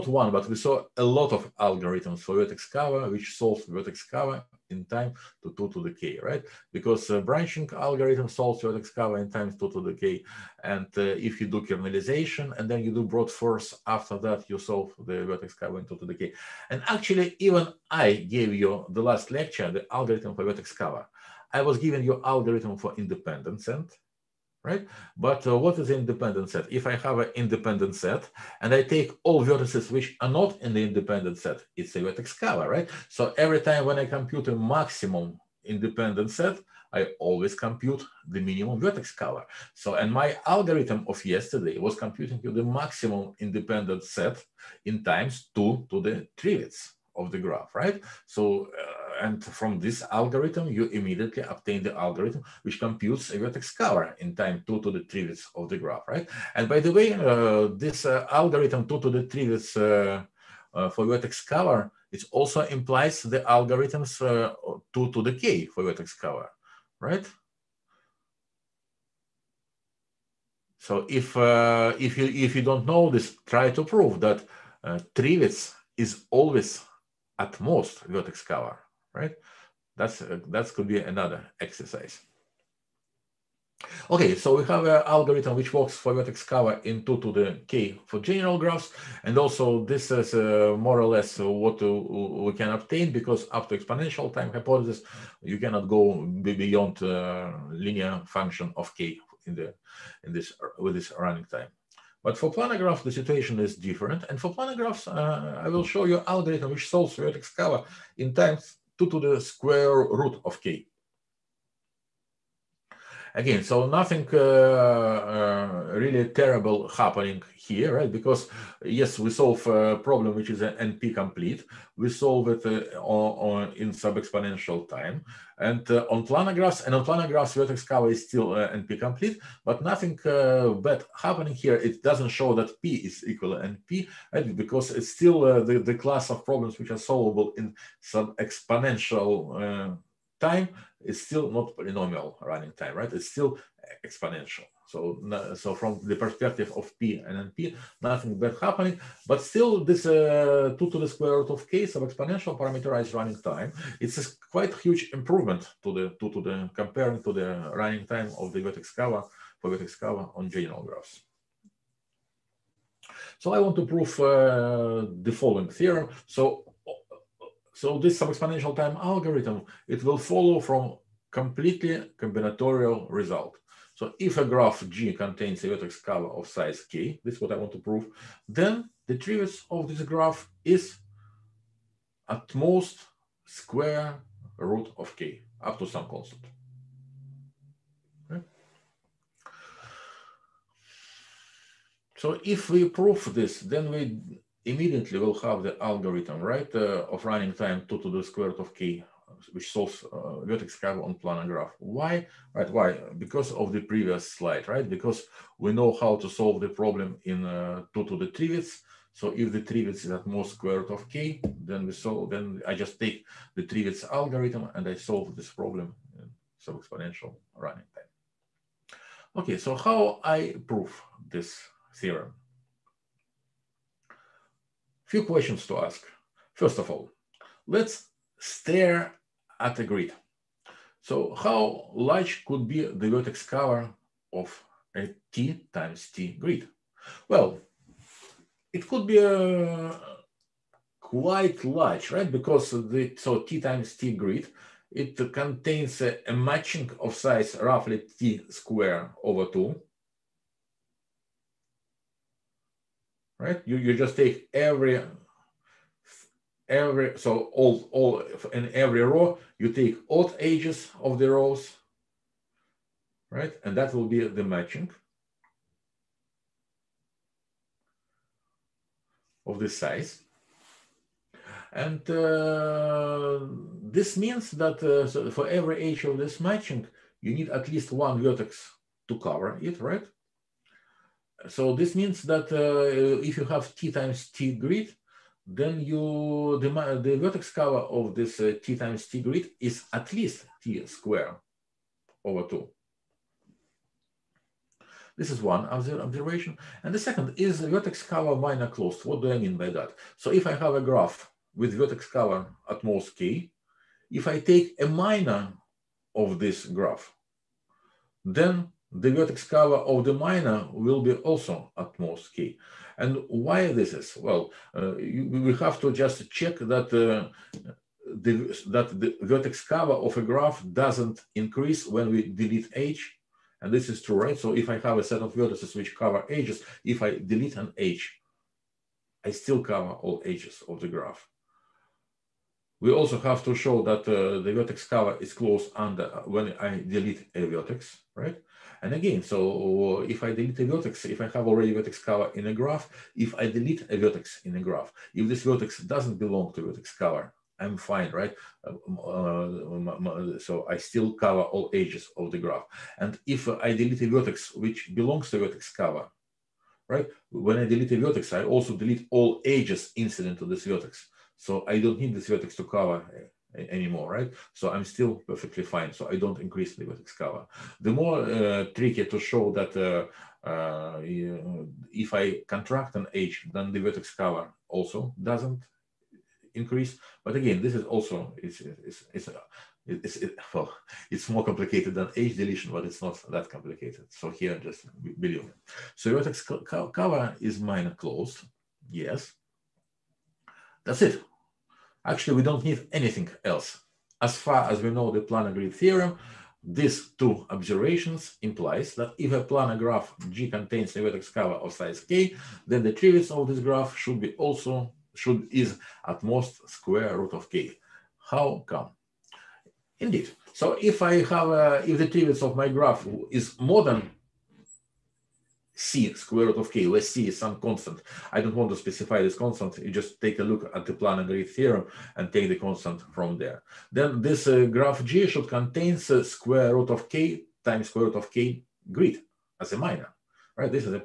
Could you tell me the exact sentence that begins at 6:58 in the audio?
I don't want to specify this constant.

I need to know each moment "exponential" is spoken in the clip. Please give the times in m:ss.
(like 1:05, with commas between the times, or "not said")
1:33, 2:03, 2:18, 2:24, 2:32, 2:48, 3:36.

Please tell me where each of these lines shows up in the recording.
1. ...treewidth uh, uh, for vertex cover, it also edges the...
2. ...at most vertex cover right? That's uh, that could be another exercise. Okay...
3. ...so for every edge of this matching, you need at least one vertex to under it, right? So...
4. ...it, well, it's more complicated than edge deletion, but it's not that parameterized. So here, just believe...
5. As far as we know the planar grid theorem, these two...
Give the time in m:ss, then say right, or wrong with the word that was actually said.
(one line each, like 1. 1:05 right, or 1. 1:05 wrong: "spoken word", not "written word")
1. 0:59 wrong: "implies", not "edges"
2. 1:17 right
3. 4:35 wrong: "cover", not "under"
4. 6:20 wrong: "complicated", not "parameterized"
5. 6:34 right.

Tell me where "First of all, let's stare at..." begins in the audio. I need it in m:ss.
3:46.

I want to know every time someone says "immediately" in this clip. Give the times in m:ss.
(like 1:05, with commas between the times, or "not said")
0:50, 3:14.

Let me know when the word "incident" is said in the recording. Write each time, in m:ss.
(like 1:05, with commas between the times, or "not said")
5:59.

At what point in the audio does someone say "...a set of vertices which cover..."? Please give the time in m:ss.
5:24.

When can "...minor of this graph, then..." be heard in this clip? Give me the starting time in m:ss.
5:04.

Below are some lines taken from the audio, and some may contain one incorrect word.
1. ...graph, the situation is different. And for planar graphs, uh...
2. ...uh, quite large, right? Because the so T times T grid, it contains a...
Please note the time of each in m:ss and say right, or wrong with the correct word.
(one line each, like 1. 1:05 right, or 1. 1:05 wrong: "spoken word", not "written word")
1. 1:42 right
2. 3:59 right.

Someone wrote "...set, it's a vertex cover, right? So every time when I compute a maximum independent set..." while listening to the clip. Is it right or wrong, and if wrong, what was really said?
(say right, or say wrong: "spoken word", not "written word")
right.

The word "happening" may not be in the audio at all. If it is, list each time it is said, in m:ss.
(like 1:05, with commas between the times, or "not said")
1:56, 2:11, 2:28.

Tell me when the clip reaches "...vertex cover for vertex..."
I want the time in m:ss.
2:38.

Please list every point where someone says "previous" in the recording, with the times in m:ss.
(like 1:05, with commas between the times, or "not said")
3:23.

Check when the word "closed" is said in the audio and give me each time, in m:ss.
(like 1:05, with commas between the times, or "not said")
4:58, 5:35, 6:27.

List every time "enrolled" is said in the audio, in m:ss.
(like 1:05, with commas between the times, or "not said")
not said.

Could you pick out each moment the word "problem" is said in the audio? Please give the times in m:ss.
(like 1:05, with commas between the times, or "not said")
1:59, 2:16, 3:26, 3:35.